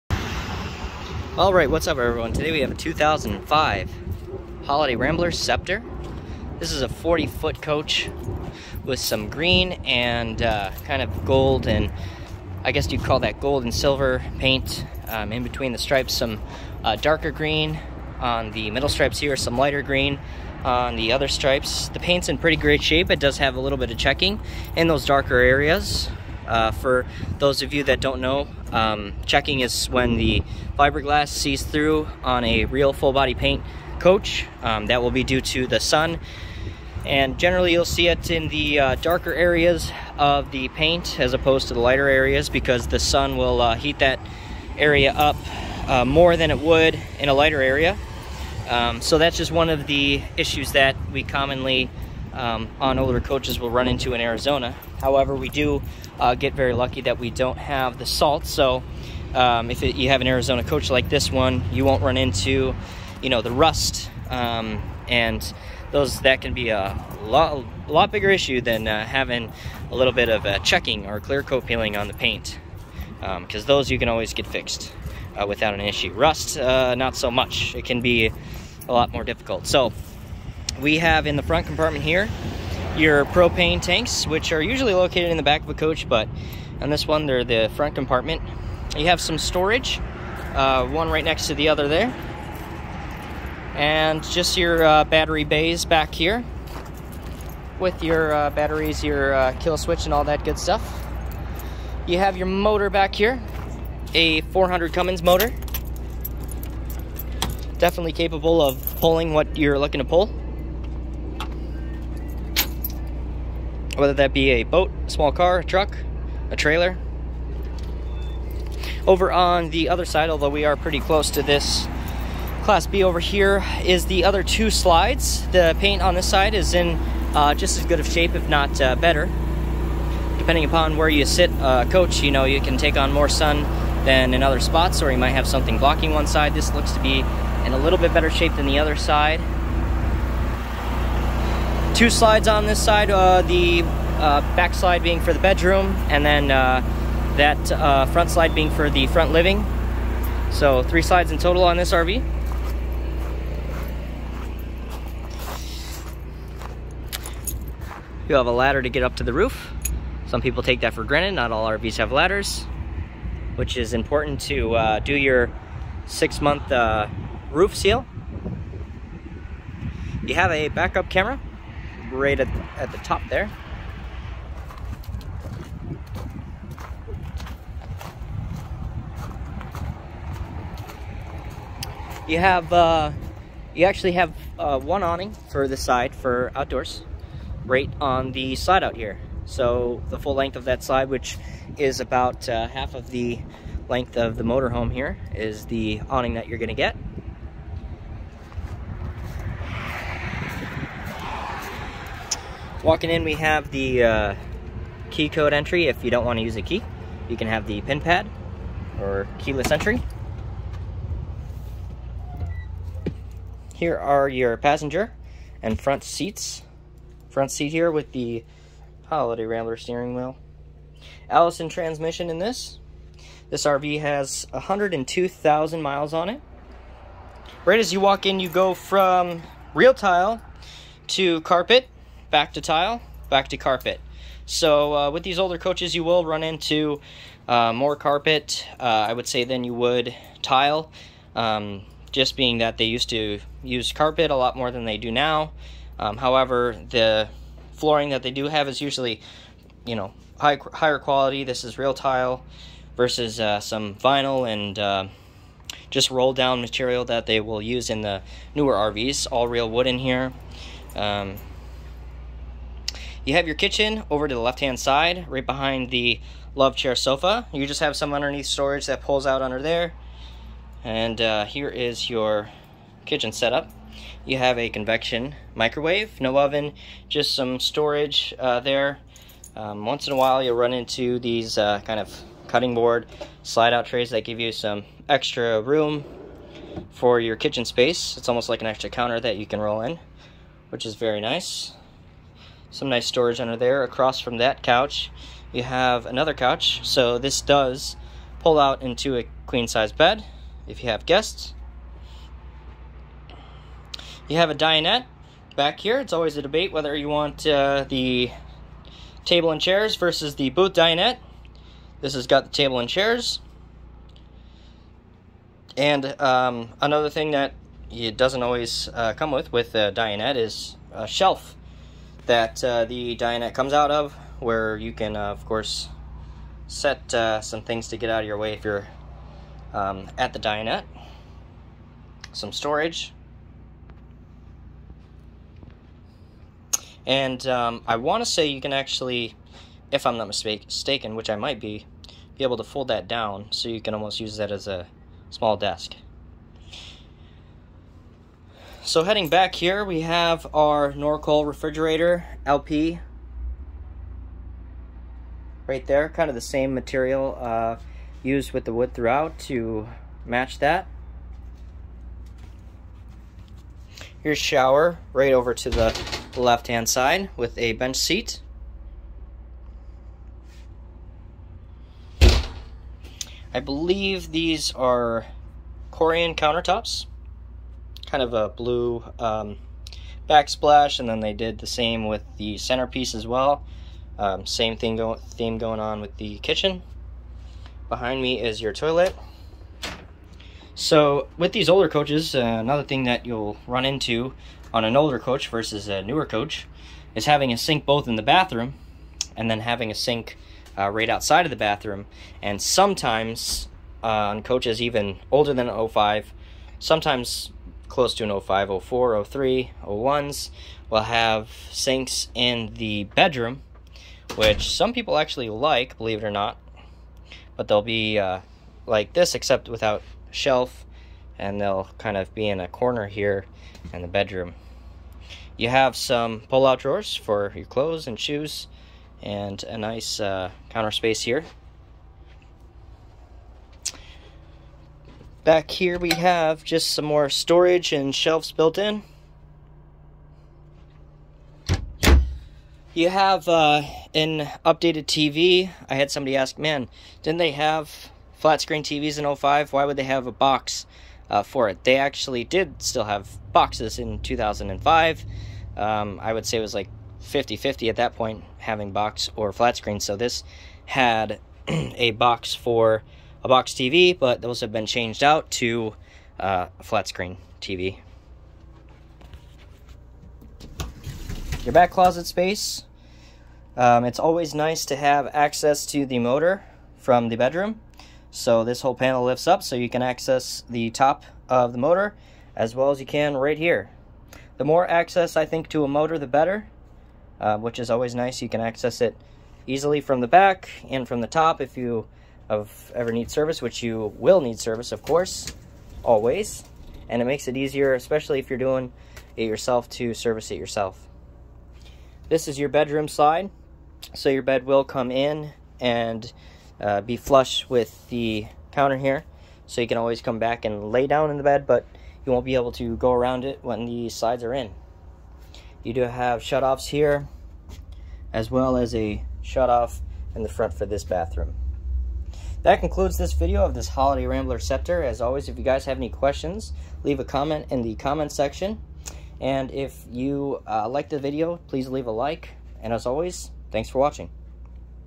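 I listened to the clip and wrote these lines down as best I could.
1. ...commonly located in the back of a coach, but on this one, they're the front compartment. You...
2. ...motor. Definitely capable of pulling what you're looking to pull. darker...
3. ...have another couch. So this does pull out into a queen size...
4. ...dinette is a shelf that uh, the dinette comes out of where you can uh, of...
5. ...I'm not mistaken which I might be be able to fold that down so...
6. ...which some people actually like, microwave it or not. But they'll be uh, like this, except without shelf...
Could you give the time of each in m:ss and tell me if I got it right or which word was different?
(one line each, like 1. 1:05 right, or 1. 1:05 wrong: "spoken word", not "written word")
1. 1:24 wrong: "usually", not "commonly"
2. 1:45 wrong: "whether", not "darker"
3. 4:55 right
4. 5:19 right
5. 5:40 right
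6. 6:54 wrong: "believe", not "microwave".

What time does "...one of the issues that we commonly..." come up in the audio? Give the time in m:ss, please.
0:49.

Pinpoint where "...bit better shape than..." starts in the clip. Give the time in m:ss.
2:17.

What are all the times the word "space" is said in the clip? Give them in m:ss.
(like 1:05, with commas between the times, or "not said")
4:47, 7:10, 7:52.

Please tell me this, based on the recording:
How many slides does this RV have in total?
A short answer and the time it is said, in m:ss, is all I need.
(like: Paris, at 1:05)
3, at 2:30.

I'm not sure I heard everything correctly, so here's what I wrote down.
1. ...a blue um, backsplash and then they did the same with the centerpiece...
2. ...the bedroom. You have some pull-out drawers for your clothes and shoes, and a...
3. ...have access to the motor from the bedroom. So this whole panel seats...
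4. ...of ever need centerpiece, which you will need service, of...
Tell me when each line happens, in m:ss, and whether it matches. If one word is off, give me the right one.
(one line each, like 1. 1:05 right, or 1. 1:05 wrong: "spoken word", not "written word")
1. 6:18 right
2. 7:04 right
3. 7:54 wrong: "lifts", not "seats"
4. 8:12 wrong: "service", not "centerpiece".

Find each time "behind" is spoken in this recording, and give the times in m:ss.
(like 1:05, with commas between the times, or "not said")
4:25, 6:27.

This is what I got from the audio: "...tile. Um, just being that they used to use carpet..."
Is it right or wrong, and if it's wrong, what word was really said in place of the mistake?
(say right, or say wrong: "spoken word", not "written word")
right.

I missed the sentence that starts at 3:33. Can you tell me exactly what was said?
Here are your passenger and front seats.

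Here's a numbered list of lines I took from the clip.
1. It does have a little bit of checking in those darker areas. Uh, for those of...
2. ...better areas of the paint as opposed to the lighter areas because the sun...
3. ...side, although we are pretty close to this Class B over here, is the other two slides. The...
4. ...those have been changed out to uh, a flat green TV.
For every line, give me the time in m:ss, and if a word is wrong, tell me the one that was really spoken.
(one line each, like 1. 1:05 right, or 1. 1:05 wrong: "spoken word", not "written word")
1. 0:23 right
2. 0:38 wrong: "darker", not "better"
3. 2:00 right
4. 7:44 wrong: "screen", not "green".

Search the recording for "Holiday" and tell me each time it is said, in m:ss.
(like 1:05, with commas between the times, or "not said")
0:04, 3:39, 8:43.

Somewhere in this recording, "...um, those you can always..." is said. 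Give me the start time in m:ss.
1:13.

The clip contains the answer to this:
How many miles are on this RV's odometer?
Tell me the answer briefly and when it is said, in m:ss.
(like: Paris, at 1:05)
102,000, at 3:44.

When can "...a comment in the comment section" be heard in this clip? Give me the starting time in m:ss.
8:47.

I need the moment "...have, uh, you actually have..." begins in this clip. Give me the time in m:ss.
3:02.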